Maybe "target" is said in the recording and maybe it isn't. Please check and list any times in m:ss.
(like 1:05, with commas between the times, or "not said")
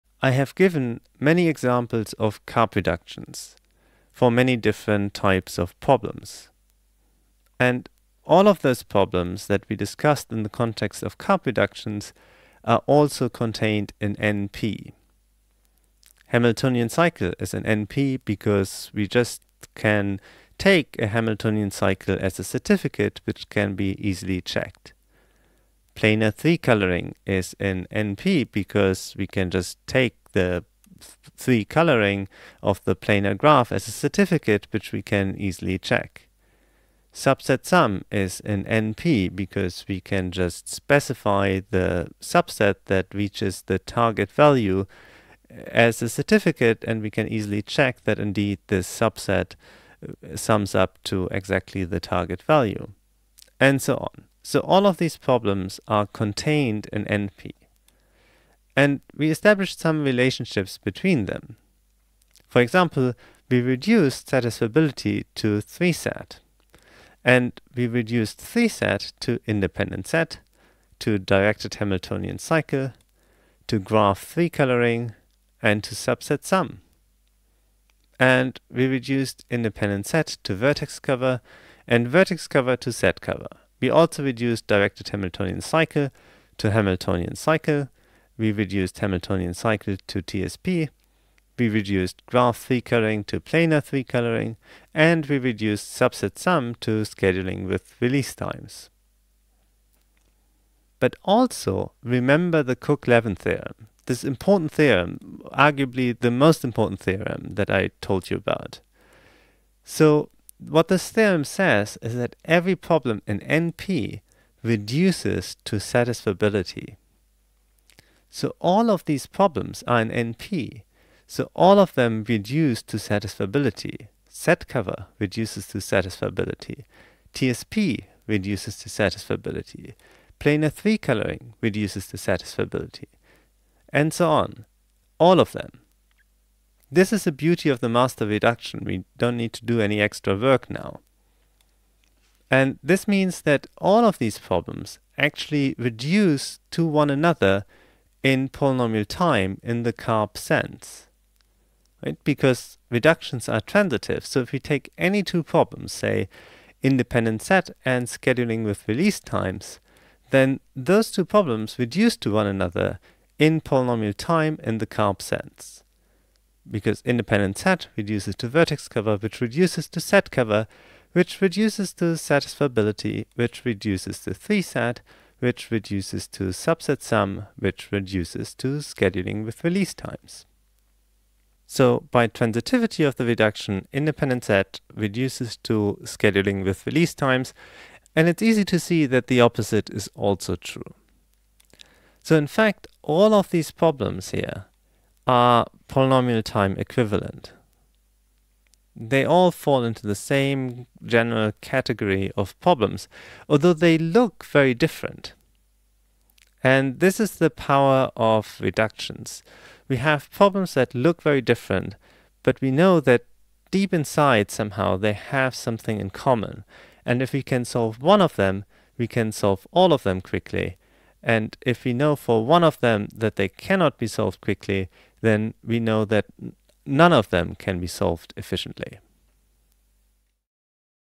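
0:43, 0:51.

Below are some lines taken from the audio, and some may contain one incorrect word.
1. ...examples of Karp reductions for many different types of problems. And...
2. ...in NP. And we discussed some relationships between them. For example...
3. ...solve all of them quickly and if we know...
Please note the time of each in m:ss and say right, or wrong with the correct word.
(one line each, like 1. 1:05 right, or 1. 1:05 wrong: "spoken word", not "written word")
1. 0:01 right
2. 0:56 wrong: "established", not "discussed"
3. 3:39 right.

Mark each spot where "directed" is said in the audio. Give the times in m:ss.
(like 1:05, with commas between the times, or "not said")
1:11, 1:24.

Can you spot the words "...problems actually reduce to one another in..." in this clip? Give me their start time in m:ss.
2:24.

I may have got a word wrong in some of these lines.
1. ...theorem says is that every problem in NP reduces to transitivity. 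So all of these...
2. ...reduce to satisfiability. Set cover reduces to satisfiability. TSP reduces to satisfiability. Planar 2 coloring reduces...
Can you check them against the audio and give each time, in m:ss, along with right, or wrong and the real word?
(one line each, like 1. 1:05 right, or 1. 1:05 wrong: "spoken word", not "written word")
1. 1:51 wrong: "satisfiability", not "transitivity"
2. 2:02 wrong: "3", not "2".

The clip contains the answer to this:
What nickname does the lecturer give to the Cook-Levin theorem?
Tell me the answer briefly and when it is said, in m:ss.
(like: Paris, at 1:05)
The master reduction, at 2:17.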